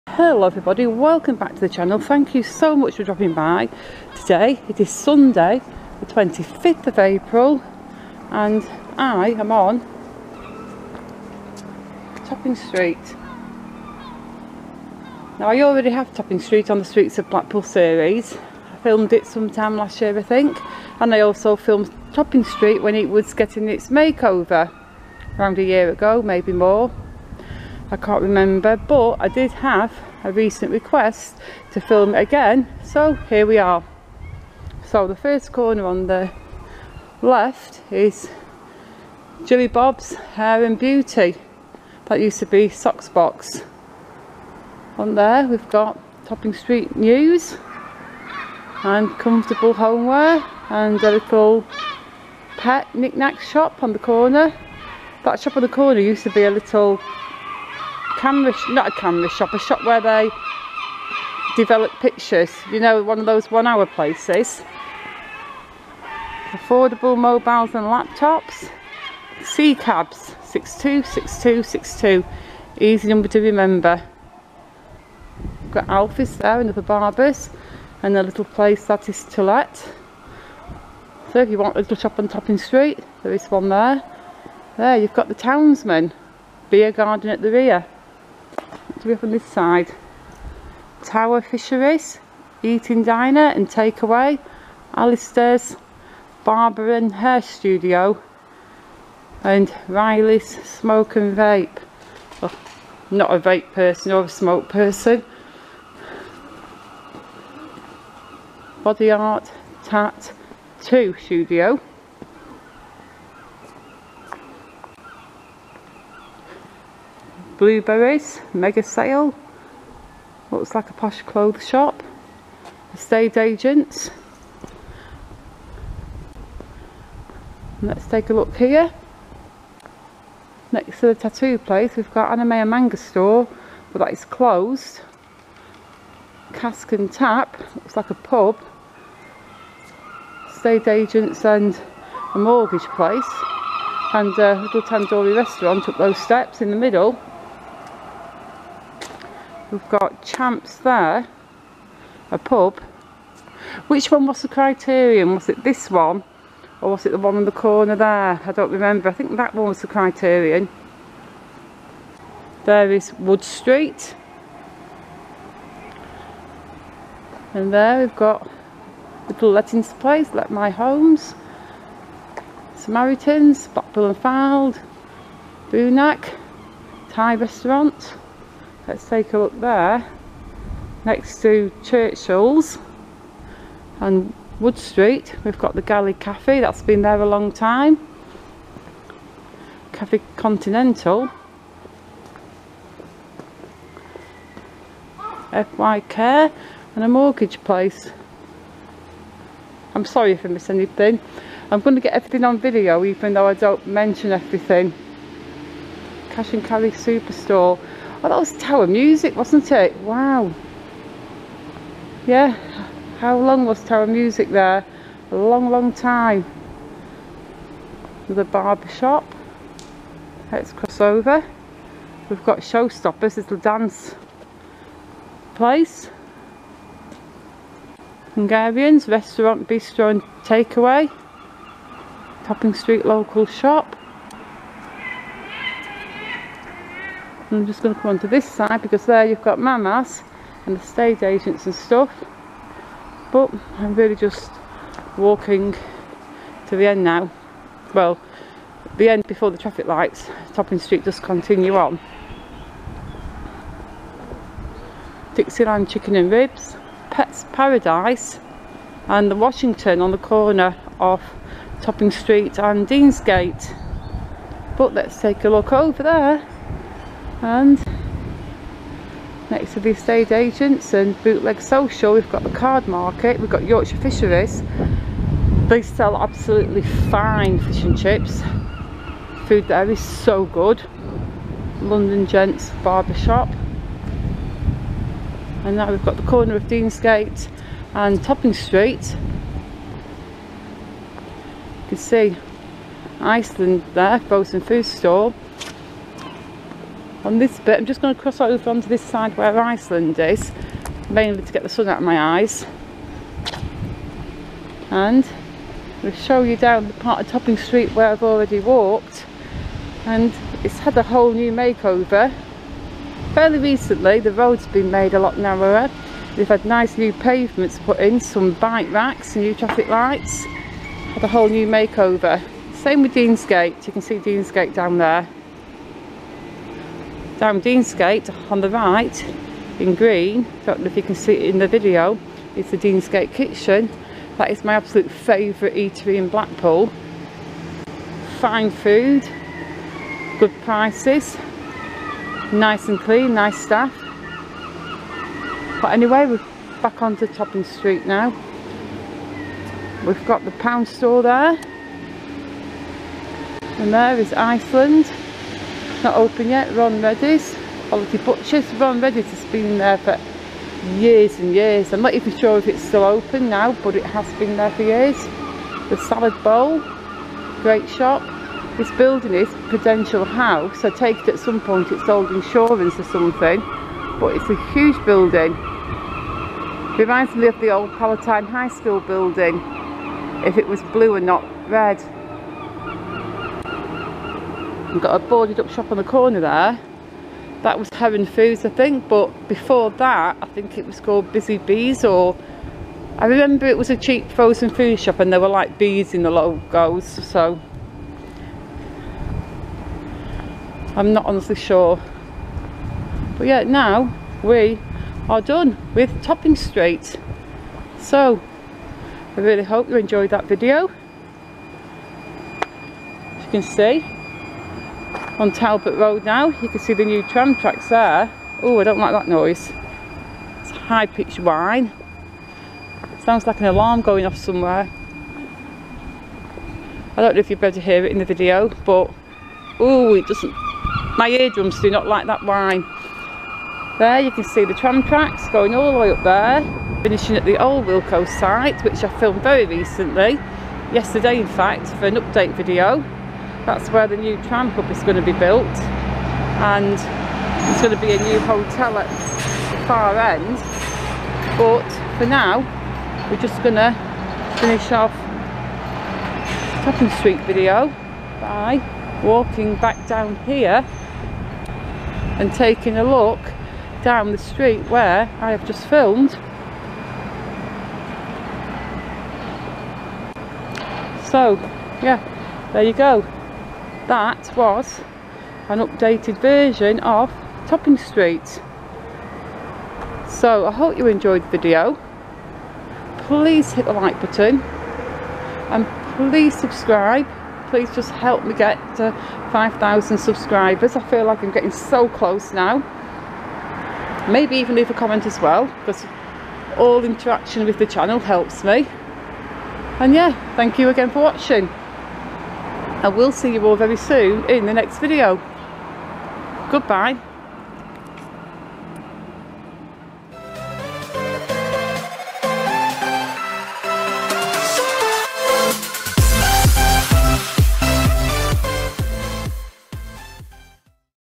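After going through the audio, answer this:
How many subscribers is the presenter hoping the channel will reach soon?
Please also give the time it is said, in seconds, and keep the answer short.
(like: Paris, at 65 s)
5,000, at 489 s.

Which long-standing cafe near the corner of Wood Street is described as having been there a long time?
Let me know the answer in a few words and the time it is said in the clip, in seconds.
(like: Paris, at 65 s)
Galley Cafe, at 185 s.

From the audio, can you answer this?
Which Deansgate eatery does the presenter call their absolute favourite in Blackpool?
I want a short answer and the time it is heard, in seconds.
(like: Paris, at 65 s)
Deansgate Kitchen, at 332 s.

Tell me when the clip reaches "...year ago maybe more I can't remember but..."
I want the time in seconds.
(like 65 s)
25 s.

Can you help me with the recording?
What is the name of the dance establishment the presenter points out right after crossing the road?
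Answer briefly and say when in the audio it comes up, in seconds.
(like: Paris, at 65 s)
Showstoppers, at 222 s.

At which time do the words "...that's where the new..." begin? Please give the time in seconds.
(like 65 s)
443 s.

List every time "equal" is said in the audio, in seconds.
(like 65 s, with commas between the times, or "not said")
not said.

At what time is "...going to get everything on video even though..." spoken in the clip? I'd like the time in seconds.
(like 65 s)
201 s.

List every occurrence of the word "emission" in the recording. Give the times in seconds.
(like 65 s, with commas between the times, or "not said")
not said.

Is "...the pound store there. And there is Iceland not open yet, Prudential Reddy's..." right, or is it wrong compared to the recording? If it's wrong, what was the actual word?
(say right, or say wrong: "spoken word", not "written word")
wrong: "Ron", not "Prudential".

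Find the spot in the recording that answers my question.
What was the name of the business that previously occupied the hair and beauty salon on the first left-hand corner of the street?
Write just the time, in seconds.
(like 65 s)
42 s.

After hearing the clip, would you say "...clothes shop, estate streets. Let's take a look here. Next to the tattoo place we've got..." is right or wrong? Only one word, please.
wrong.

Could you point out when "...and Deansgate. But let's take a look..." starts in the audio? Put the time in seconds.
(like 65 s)
262 s.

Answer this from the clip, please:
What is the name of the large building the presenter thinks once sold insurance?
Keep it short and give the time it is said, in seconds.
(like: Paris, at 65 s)
Prudential House, at 369 s.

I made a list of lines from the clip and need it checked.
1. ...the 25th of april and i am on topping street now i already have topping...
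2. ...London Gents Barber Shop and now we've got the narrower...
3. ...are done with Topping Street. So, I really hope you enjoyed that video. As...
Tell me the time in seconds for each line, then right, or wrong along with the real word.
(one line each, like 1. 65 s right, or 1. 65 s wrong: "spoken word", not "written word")
1. 5 s right
2. 281 s wrong: "corner", not "narrower"
3. 405 s right.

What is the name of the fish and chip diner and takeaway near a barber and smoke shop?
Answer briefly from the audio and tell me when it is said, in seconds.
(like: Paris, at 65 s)
Tower Fisheries, at 91 s.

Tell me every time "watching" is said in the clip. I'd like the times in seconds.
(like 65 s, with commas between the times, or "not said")
501 s.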